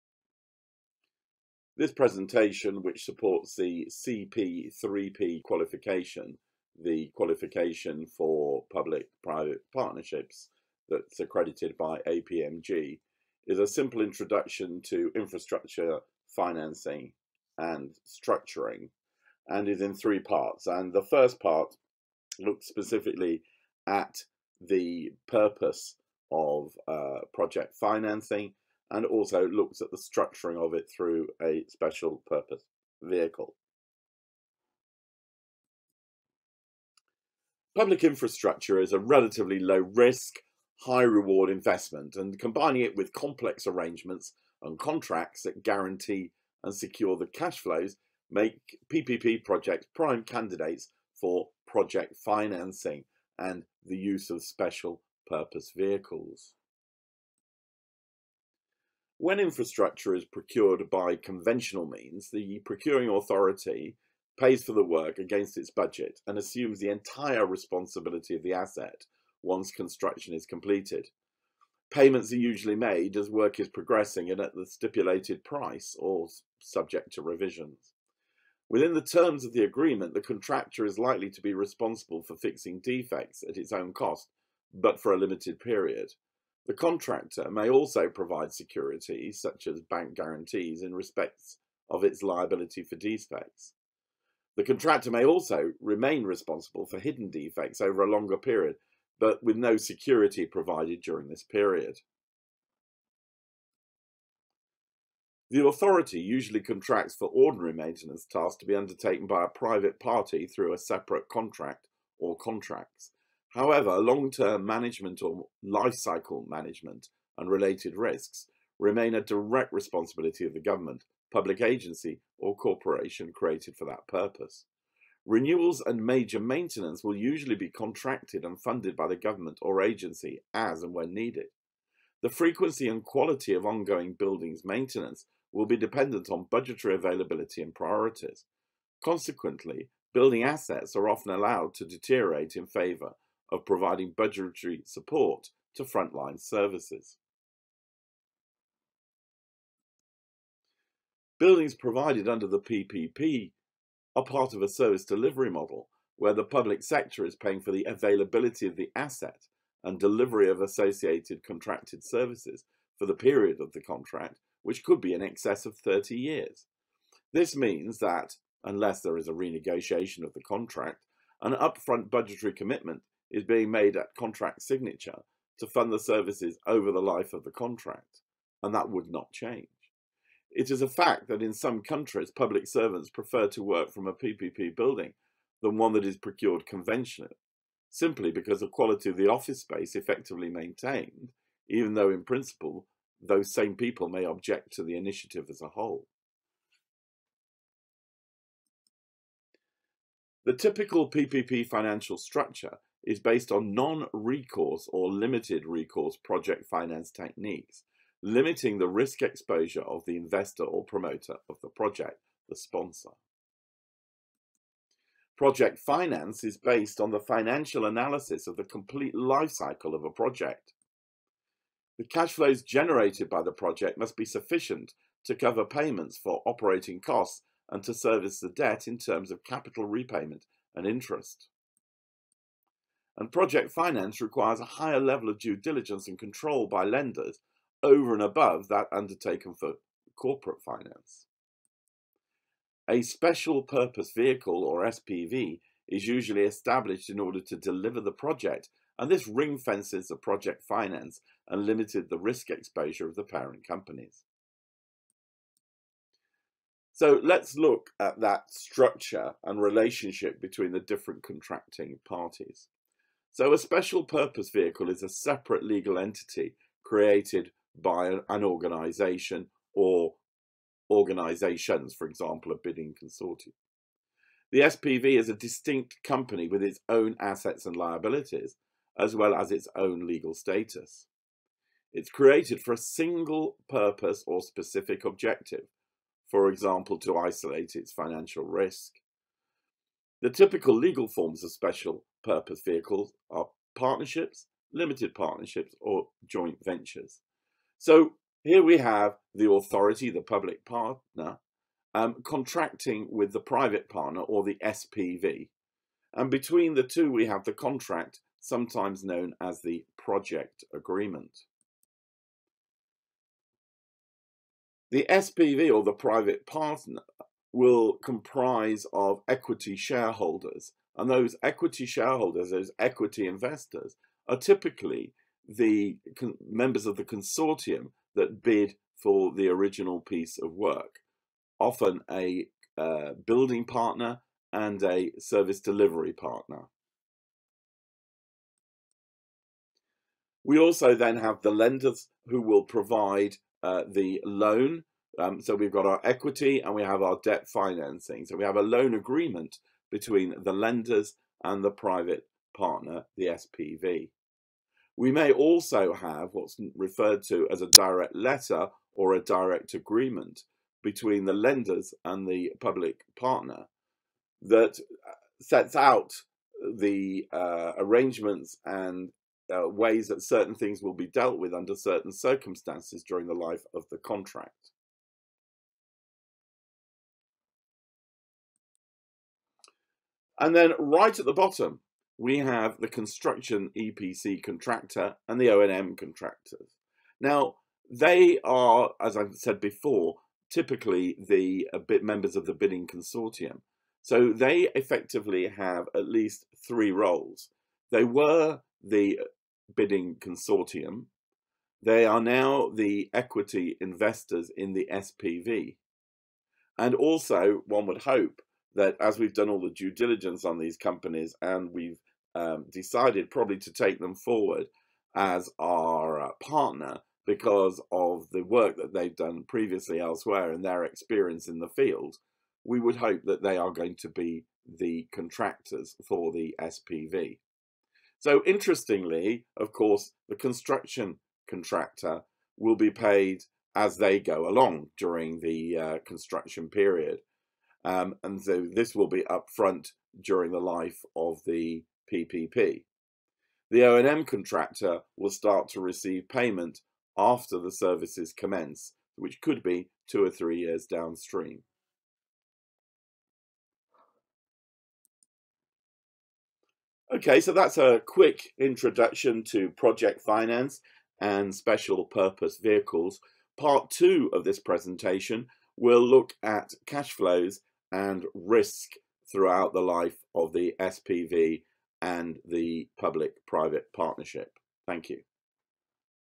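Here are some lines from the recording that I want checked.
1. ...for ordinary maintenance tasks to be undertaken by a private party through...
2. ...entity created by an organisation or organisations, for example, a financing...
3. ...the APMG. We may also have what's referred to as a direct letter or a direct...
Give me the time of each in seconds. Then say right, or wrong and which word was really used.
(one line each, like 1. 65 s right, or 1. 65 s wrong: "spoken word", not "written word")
1. 107 s right
2. 265 s wrong: "bidding", not "financing"
3. 353 s wrong: "SPV", not "APMG".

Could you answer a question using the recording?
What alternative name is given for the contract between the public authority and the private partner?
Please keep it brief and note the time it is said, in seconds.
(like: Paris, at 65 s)
project agreement, at 309 s.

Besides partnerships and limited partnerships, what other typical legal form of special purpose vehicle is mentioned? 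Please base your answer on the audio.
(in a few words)
joint ventures.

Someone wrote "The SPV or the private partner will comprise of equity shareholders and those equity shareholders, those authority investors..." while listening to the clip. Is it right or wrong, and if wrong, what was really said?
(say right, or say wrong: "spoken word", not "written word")
wrong: "equity", not "authority".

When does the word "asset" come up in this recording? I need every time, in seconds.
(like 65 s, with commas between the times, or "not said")
68 s, 140 s, 158 s, 277 s.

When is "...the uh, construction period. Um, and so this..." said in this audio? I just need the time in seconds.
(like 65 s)
435 s.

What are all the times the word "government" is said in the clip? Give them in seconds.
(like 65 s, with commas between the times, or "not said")
120 s, 129 s.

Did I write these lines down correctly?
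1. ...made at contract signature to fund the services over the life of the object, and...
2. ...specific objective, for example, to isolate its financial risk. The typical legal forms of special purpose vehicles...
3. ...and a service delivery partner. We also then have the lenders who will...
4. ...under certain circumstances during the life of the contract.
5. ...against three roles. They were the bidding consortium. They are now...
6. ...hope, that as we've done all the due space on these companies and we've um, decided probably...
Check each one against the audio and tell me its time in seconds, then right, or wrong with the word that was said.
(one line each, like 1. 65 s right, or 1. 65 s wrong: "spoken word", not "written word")
1. 173 s wrong: "contract", not "object"
2. 284 s right
3. 334 s right
4. 371 s right
5. 396 s wrong: "least", not "against"
6. 408 s wrong: "diligence", not "space".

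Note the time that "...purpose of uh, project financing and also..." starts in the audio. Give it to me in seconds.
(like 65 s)
25 s.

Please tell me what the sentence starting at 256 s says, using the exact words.
So let's look at that structure and relationship between the different contracting parties.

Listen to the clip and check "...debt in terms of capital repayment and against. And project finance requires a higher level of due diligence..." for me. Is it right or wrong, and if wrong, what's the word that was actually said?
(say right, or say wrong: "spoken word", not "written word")
wrong: "interest", not "against".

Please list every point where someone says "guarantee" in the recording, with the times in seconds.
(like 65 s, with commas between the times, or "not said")
45 s, 90 s.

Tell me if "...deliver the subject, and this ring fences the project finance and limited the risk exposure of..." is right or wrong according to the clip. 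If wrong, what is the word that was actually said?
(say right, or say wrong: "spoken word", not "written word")
wrong: "project", not "subject".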